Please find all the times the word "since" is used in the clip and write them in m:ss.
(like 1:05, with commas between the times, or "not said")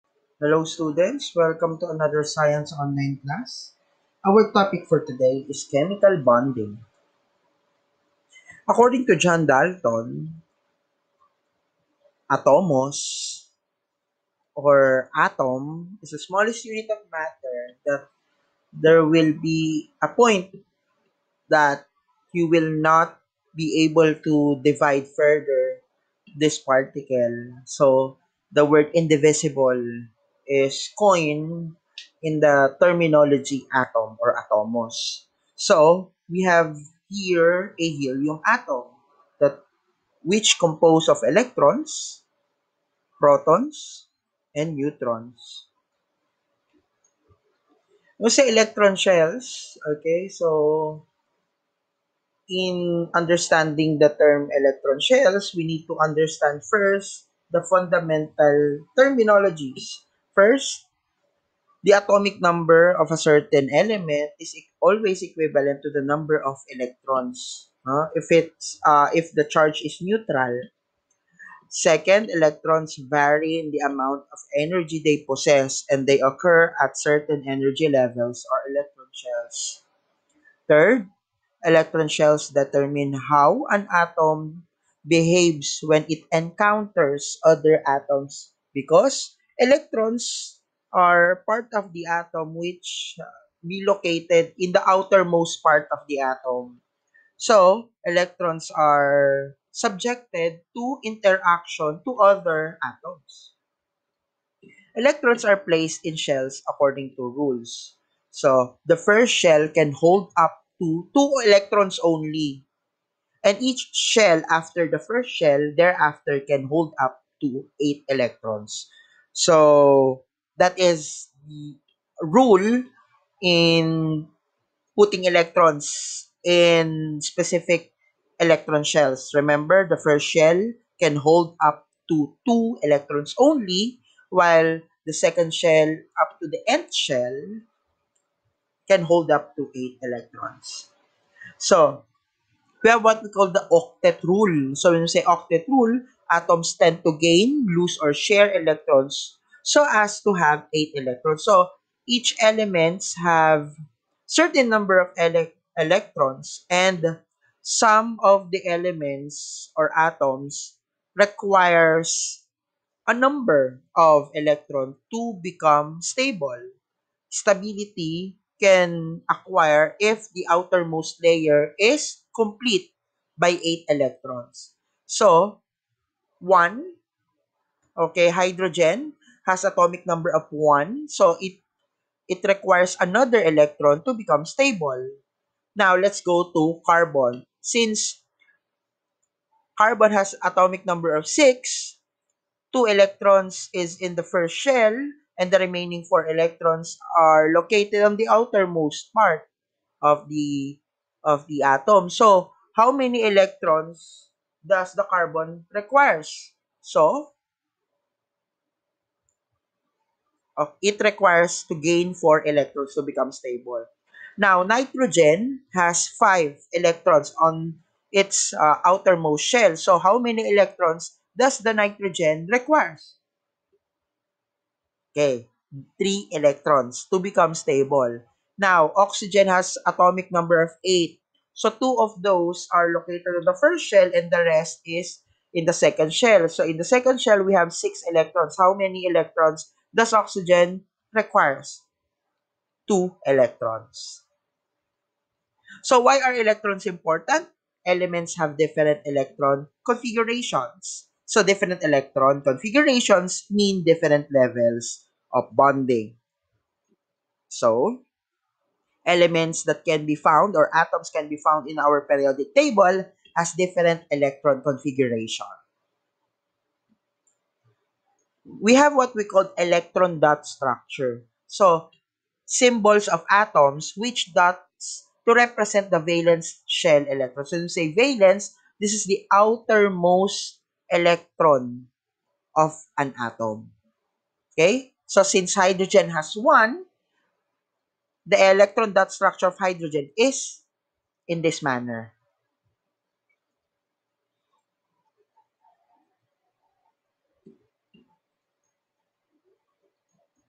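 3:07, 4:45.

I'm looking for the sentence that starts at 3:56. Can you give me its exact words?
So in the second shell, we have six electrons.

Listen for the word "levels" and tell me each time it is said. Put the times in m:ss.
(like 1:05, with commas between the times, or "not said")
1:17, 4:14.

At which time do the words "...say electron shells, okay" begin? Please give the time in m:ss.
0:48.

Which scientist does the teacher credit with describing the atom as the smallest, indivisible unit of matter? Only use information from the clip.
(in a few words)
John Dalton.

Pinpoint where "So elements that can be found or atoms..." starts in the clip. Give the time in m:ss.
4:17.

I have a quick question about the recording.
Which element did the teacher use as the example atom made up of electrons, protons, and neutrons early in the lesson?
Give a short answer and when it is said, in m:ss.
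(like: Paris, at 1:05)
helium, at 0:37.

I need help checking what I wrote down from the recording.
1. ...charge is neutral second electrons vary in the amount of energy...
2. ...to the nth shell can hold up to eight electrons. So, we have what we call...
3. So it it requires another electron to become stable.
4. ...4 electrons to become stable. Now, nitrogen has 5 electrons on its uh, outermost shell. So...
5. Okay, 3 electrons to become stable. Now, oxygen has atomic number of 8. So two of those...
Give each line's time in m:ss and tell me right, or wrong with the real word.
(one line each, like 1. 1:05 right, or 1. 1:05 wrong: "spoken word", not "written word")
1. 1:09 right
2. 2:16 right
3. 3:01 right
4. 3:32 right
5. 3:45 right.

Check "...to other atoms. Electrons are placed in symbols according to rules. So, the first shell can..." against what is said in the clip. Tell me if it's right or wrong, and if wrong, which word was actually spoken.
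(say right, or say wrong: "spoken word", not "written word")
wrong: "shells", not "symbols".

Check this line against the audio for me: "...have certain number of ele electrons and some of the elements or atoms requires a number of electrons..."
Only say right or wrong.
right.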